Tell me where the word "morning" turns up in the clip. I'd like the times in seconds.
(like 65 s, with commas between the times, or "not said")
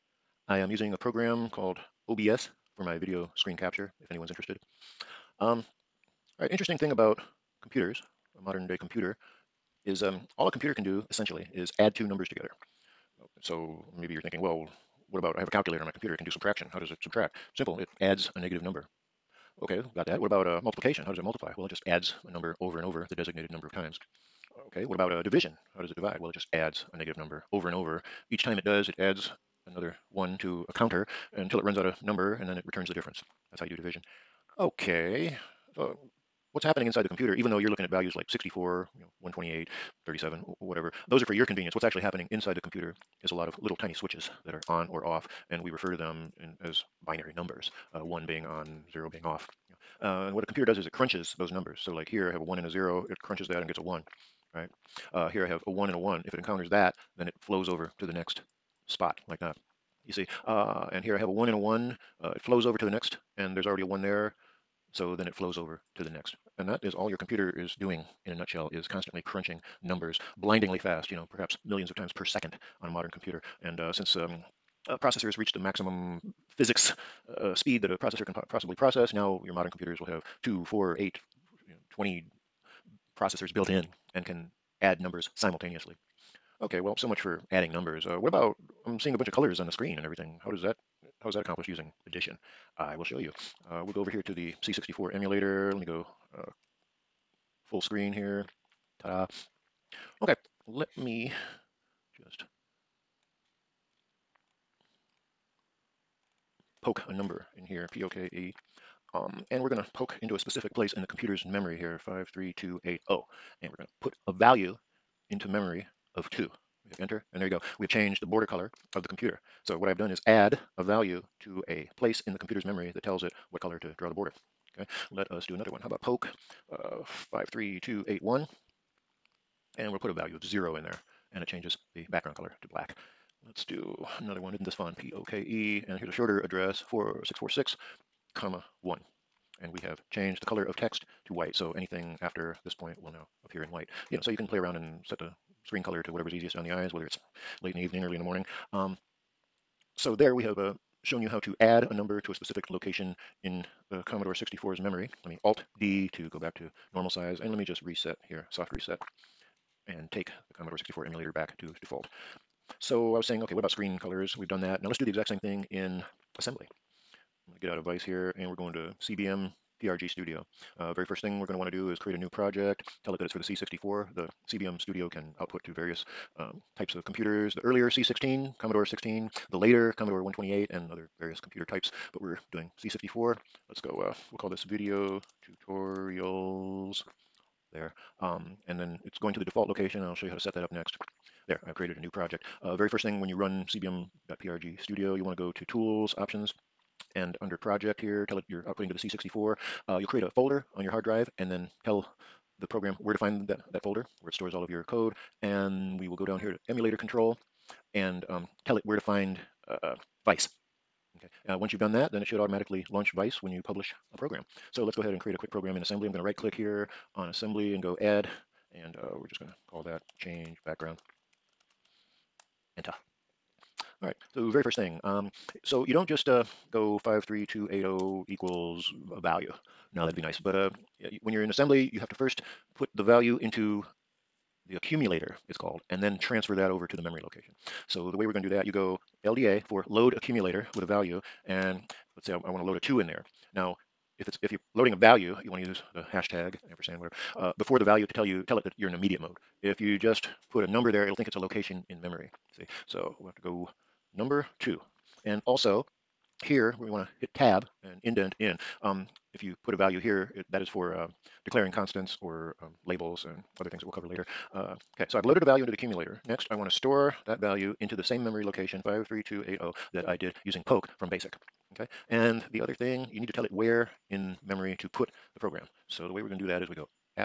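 148 s.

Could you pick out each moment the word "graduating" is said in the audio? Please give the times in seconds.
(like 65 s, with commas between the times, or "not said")
not said.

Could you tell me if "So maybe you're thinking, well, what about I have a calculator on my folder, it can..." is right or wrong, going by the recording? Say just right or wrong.
wrong.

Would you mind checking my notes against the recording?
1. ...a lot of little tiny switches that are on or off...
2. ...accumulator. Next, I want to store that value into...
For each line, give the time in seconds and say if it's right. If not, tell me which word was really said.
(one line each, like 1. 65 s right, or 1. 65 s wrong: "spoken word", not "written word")
1. 43 s right
2. 265 s right.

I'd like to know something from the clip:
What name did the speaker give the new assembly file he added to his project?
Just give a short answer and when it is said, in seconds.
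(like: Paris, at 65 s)
change background, at 220 s.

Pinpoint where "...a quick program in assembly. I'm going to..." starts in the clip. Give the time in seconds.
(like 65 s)
215 s.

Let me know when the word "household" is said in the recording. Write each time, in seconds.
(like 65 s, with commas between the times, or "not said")
not said.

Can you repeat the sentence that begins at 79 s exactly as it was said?
Now your modern computers will have 2, 4, 8, you know, 20 processors built in and can add numbers simultaneously.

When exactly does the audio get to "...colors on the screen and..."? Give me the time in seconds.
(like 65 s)
89 s.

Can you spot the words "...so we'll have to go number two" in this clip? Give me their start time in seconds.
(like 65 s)
252 s.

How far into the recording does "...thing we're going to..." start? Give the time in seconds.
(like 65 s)
171 s.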